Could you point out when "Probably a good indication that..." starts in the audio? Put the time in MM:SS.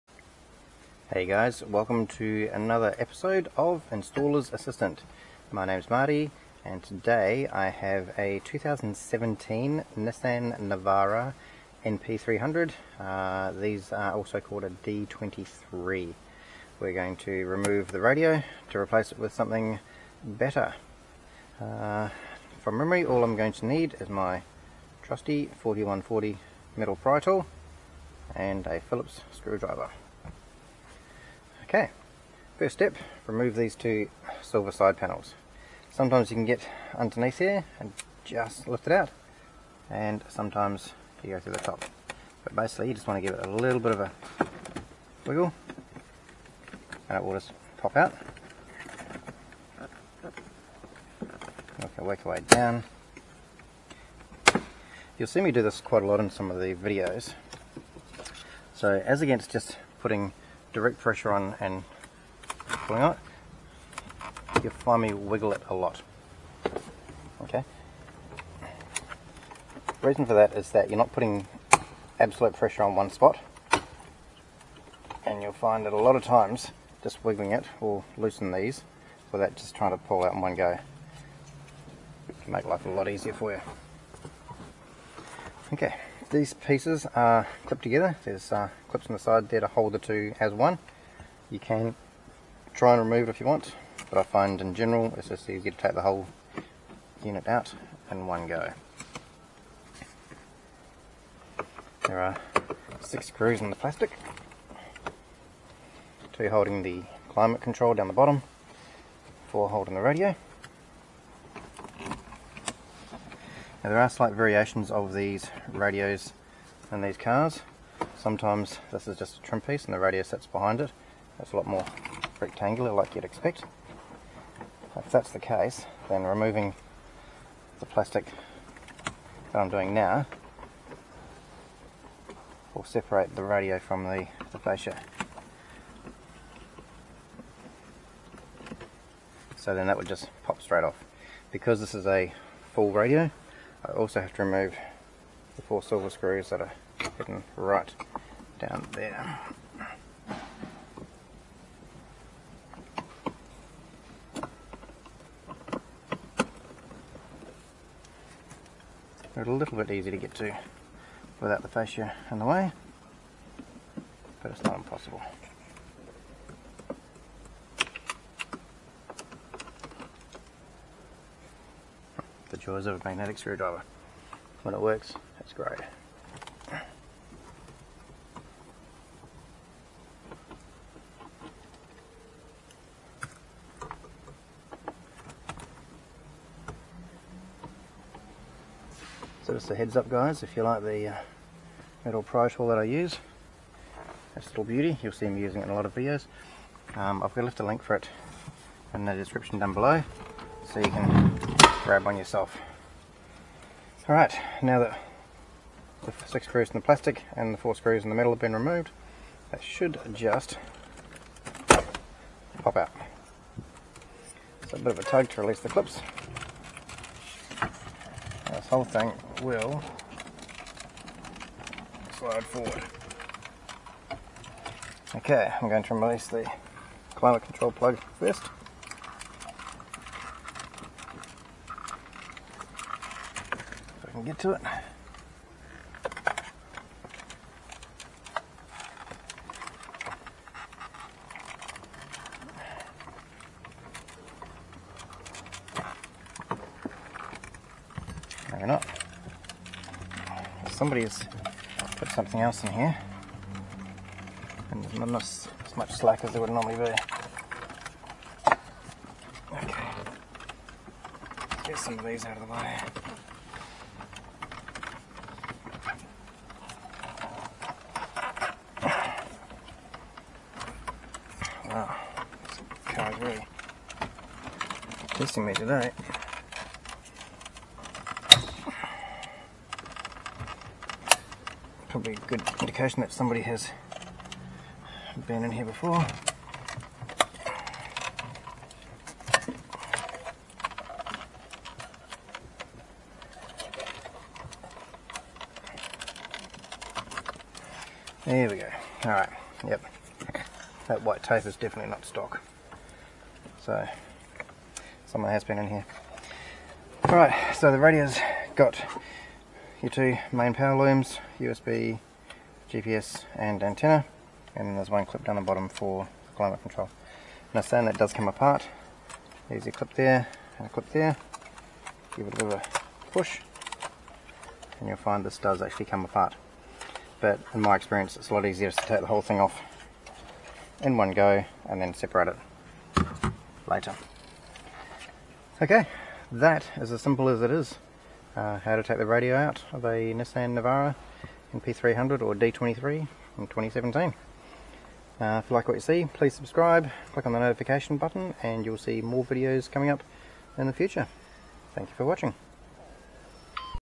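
04:41.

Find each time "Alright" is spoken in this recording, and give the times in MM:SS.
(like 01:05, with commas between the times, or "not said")
04:59, 05:07.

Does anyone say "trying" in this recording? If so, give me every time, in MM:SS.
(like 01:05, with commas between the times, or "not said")
01:19.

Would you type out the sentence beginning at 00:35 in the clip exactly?
Sometimes you can get underneath here and just lift it out, and sometimes you go through the top.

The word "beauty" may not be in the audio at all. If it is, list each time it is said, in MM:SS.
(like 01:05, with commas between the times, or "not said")
03:14.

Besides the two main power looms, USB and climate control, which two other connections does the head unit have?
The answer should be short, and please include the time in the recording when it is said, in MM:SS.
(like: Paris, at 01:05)
GPS and antenna, at 05:12.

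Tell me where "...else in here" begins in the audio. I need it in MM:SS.
04:12.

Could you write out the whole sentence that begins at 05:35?
Okay, that is as simple as it is.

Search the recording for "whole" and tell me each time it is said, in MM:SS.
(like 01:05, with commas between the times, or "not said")
01:36, 03:38, 05:29.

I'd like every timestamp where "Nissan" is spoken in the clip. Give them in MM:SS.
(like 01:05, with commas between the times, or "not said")
00:09, 05:40.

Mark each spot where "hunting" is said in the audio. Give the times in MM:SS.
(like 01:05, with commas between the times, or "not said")
not said.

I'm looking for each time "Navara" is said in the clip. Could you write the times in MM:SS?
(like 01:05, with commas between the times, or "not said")
00:10, 05:40.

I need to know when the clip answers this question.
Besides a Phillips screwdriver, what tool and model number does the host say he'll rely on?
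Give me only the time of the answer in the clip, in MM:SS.
00:25.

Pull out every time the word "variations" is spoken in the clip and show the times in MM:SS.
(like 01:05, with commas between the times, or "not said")
01:54.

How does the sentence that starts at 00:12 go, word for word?
Uh, these are also called a D23.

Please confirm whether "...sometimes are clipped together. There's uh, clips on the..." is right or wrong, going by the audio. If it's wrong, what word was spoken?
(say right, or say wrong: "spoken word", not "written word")
wrong: "pieces", not "sometimes".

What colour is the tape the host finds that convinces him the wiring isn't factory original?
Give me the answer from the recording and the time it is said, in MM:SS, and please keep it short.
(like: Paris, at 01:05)
White, at 05:01.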